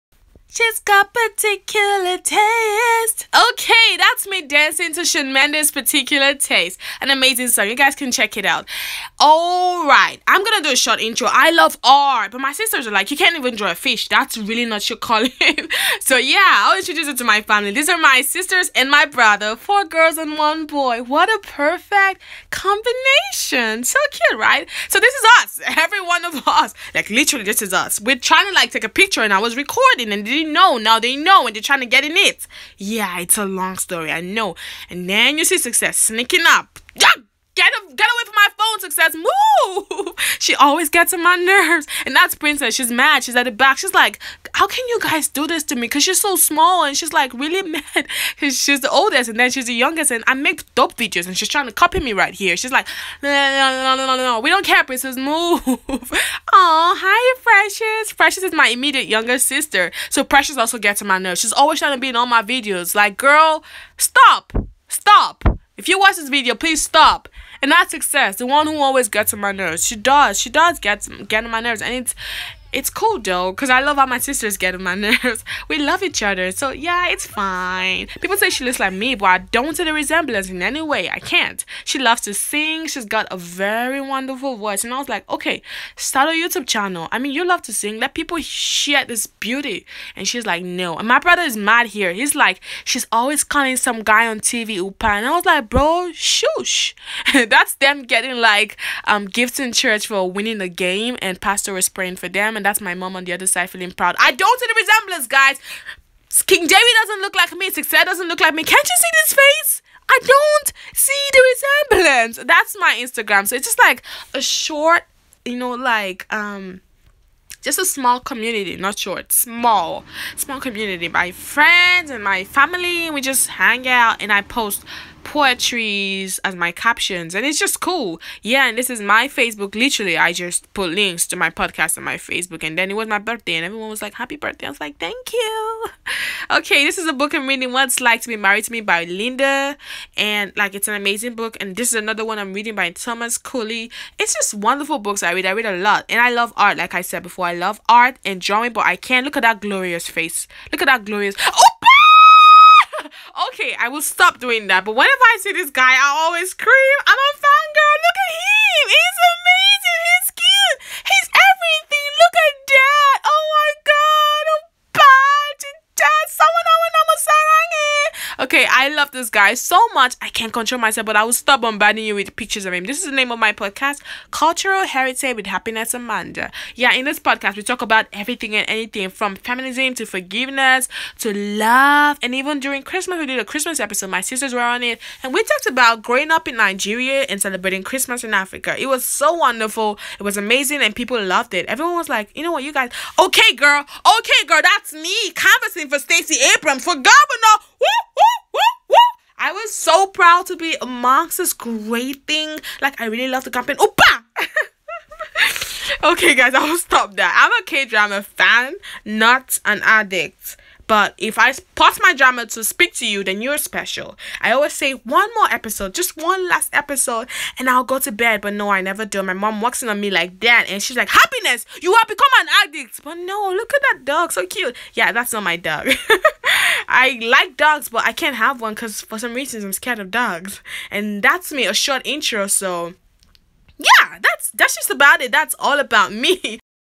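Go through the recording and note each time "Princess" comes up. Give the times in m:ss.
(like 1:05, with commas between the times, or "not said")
0:42, 0:54.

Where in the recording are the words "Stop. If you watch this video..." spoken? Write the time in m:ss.
1:04.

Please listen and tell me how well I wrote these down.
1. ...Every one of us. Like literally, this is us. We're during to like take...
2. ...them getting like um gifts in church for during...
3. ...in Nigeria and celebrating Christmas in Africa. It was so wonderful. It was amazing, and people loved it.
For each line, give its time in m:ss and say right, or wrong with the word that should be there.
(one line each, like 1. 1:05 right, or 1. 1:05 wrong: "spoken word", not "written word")
1. 0:25 wrong: "trying", not "during"
2. 1:37 wrong: "winning", not "during"
3. 3:06 right.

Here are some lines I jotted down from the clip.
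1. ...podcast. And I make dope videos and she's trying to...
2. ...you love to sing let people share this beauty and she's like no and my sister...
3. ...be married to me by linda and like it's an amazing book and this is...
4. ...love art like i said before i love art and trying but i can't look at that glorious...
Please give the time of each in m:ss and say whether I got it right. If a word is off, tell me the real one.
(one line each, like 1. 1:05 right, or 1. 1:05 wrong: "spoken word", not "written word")
1. 0:49 wrong: "youngest", not "podcast"
2. 1:27 wrong: "brother", not "sister"
3. 2:18 right
4. 2:26 wrong: "drawing", not "trying".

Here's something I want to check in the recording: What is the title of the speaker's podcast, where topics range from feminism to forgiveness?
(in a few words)
Cultural Heritage with Happiness Hamandah.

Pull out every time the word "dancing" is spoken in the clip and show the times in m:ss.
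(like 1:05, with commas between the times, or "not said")
0:04.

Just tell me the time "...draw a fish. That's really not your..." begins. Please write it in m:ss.
0:13.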